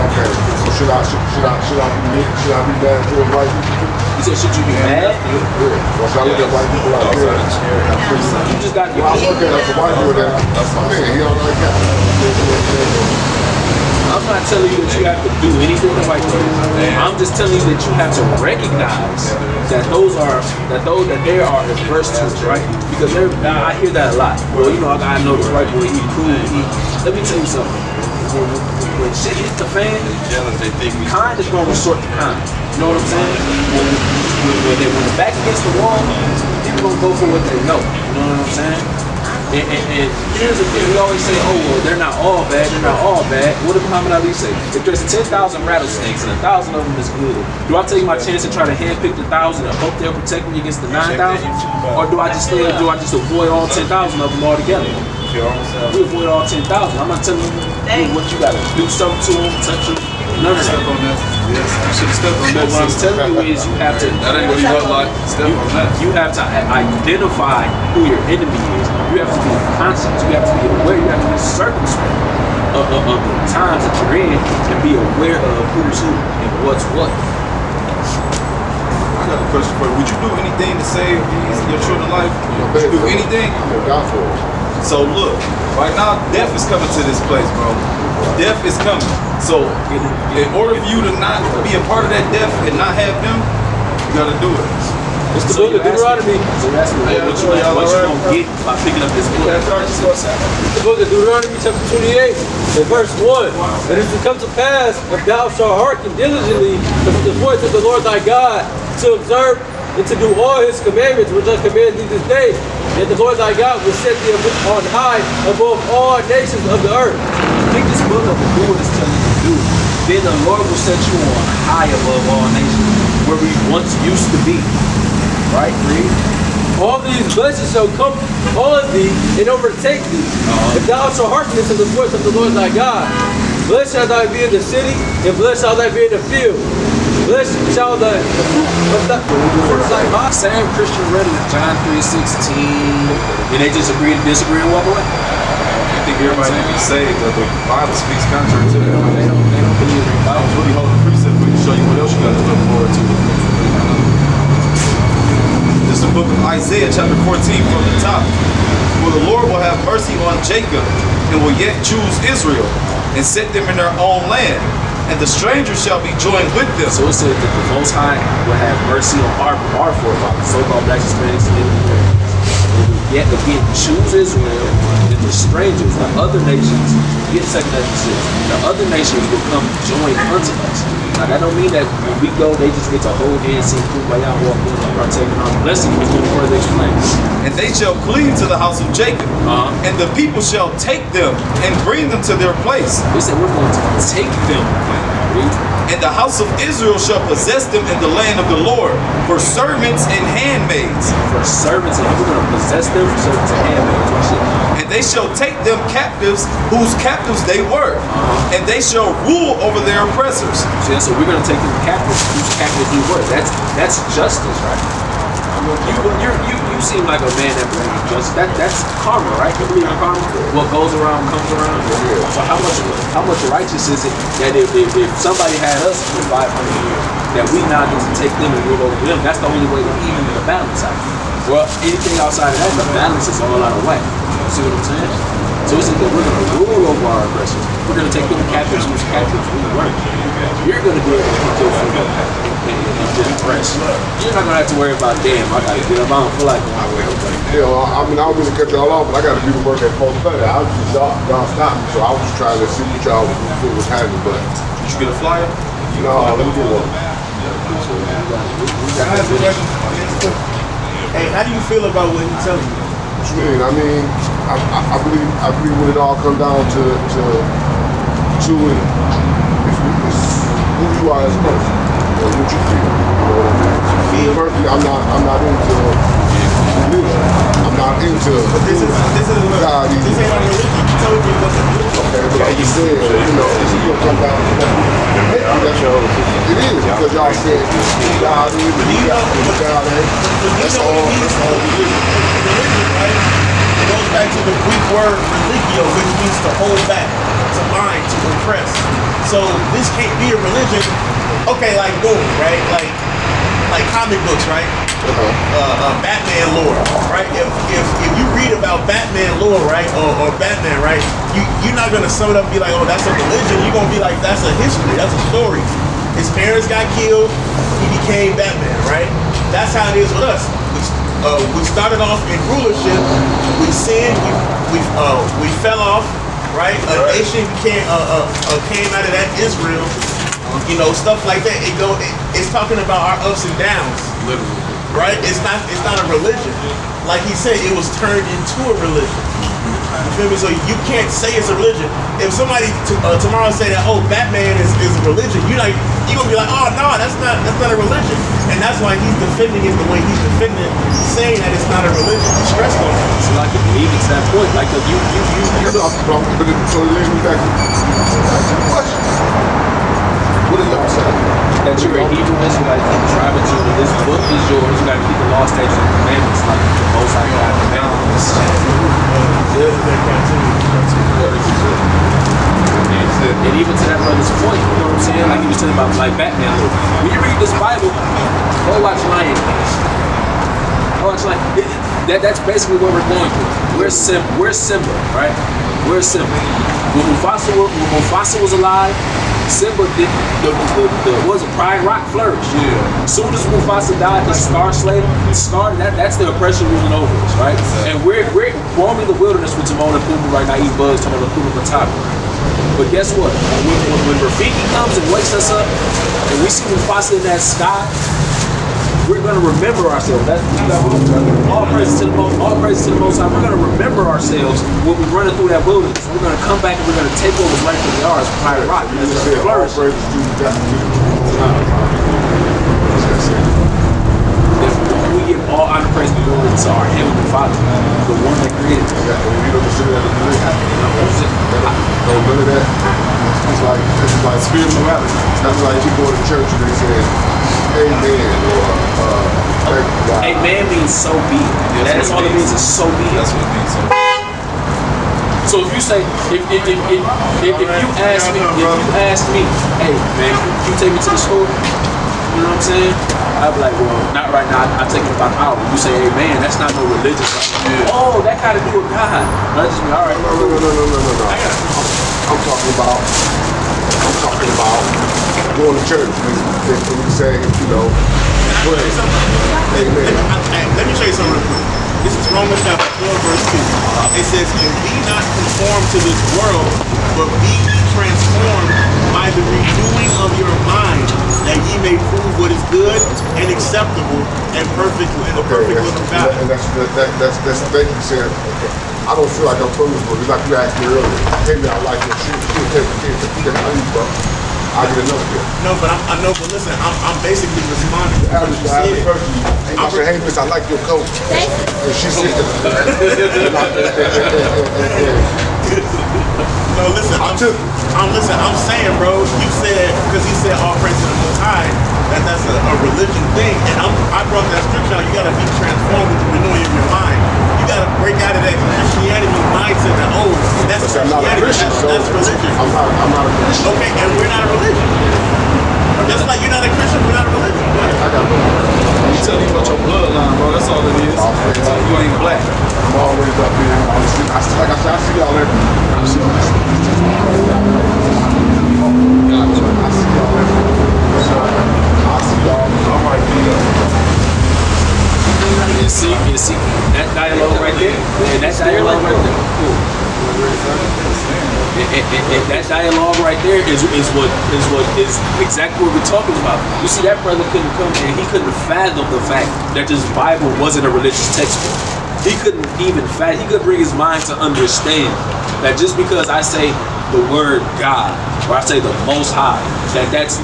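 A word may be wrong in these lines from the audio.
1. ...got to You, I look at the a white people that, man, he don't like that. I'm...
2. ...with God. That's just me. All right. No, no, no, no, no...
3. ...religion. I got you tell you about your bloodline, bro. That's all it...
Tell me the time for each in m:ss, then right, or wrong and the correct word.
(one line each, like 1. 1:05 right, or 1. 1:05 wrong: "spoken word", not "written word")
1. 0:08 wrong: "Well", not "You"
2. 7:38 right
3. 8:47 right.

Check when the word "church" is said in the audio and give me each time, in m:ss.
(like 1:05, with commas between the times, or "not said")
7:16, 7:45.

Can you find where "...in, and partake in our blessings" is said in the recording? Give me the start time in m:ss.
3:04.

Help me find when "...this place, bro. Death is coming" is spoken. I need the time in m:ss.
1:27.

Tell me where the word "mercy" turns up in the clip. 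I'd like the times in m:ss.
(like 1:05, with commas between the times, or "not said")
2:39, 2:48.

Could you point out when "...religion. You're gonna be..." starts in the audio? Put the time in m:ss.
5:13.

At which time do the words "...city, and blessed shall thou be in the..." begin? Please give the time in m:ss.
2:14.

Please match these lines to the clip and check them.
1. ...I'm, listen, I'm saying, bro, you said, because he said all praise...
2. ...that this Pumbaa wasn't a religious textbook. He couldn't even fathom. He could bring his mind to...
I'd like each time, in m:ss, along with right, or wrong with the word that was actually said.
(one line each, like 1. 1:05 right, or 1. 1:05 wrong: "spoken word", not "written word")
1. 8:27 right
2. 9:19 wrong: "Bible", not "Pumbaa".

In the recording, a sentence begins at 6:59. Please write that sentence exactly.
We give all honor, praise, and glory to our Heavenly Father, the one that created us.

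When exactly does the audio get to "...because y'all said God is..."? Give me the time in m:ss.
4:46.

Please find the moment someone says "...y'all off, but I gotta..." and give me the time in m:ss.
4:08.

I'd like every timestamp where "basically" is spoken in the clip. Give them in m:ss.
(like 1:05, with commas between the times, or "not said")
6:22, 8:17.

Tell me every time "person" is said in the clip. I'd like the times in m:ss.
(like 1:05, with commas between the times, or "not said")
4:31.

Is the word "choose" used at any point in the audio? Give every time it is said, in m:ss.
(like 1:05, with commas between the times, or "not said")
2:41, 2:53.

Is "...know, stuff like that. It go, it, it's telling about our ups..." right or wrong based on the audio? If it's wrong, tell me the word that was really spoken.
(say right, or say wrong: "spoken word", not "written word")
wrong: "talking", not "telling".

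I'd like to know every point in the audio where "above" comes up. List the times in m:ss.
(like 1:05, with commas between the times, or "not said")
1:55, 2:01.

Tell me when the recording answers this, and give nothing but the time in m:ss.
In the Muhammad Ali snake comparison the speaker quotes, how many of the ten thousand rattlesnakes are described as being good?
0:46.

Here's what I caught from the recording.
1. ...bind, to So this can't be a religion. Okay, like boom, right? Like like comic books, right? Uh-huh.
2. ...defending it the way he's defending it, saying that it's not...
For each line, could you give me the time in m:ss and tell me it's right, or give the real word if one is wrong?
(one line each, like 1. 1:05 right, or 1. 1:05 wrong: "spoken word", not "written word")
1. 4:57 right
2. 5:49 right.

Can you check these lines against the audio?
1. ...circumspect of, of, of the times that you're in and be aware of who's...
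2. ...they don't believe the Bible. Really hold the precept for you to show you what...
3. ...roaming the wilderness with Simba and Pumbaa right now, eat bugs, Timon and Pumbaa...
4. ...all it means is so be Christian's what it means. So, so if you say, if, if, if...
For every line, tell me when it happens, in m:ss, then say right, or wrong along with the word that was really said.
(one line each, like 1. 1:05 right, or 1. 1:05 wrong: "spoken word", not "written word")
1. 1:11 right
2. 2:29 right
3. 6:38 wrong: "Timon", not "Simba"
4. 7:22 wrong: "That", not "Christian".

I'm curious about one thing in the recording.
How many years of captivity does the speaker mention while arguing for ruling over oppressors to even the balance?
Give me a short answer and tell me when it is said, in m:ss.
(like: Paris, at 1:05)
500 years, at 3:46.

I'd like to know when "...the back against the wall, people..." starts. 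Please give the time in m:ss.
0:35.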